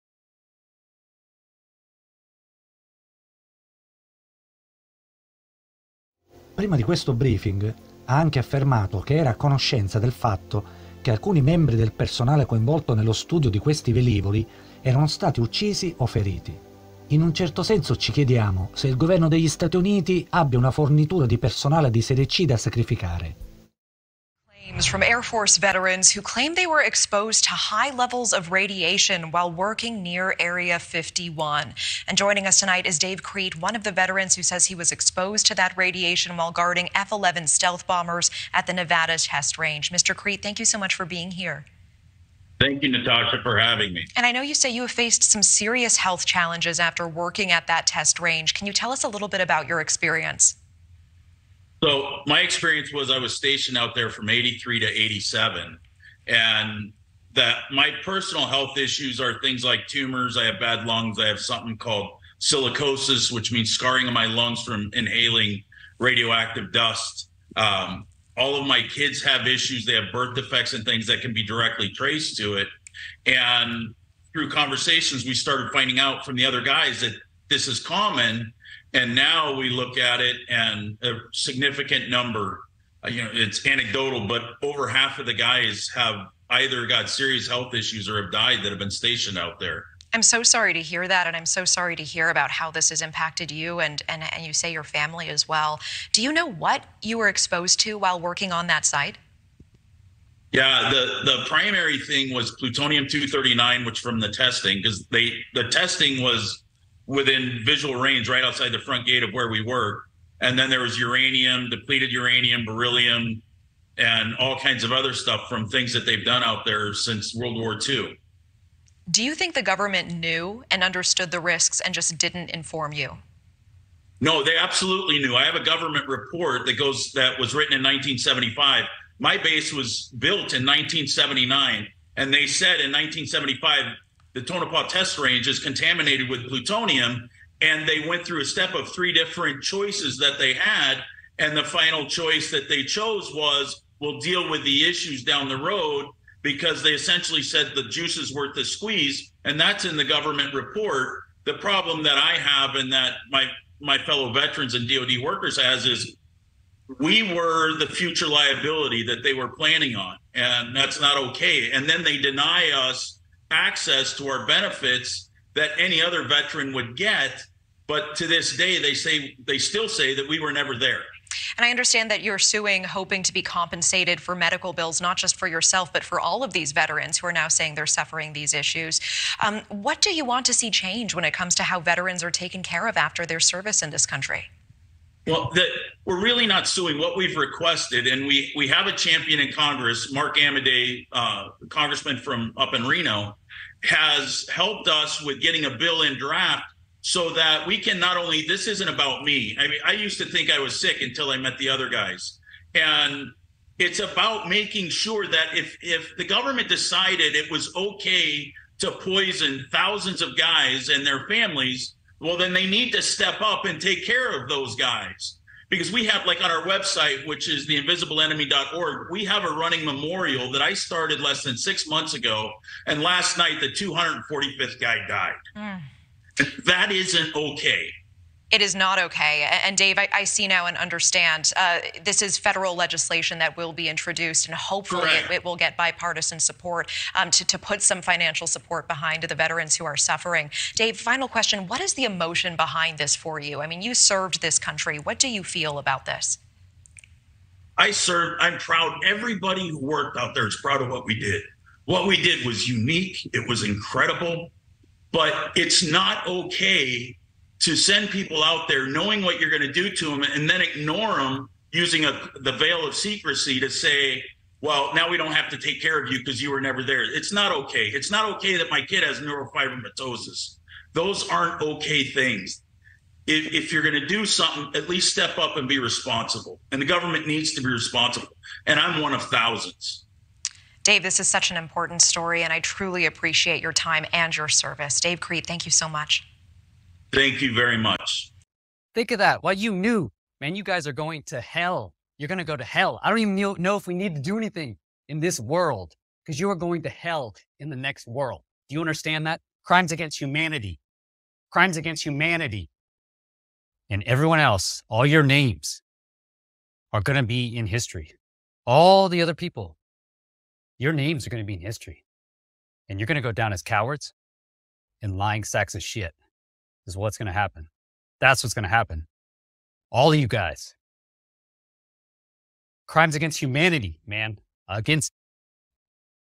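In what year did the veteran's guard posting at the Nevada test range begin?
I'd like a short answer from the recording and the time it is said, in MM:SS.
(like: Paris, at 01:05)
1983, at 00:54.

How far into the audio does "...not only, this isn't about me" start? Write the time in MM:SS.
03:17.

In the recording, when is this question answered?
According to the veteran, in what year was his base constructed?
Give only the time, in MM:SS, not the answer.
02:10.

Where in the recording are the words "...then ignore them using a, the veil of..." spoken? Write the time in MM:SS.
04:20.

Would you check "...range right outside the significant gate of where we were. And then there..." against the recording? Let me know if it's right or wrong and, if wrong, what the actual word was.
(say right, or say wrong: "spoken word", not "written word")
wrong: "front", not "significant".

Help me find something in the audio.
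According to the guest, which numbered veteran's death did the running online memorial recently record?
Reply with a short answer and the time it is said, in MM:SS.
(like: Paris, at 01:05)
245th, at 03:43.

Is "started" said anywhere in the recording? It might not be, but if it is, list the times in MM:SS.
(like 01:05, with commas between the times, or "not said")
01:15, 03:40.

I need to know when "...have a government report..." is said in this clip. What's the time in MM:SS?
02:05.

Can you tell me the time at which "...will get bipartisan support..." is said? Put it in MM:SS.
03:55.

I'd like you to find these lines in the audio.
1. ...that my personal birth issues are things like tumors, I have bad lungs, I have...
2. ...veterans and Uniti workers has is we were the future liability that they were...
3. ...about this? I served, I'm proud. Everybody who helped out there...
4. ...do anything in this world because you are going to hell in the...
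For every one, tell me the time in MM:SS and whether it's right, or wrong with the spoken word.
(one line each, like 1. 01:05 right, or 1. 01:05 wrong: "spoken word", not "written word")
1. 00:57 wrong: "health", not "birth"
2. 02:34 wrong: "DoD", not "Uniti"
3. 04:05 wrong: "worked", not "helped"
4. 04:54 right.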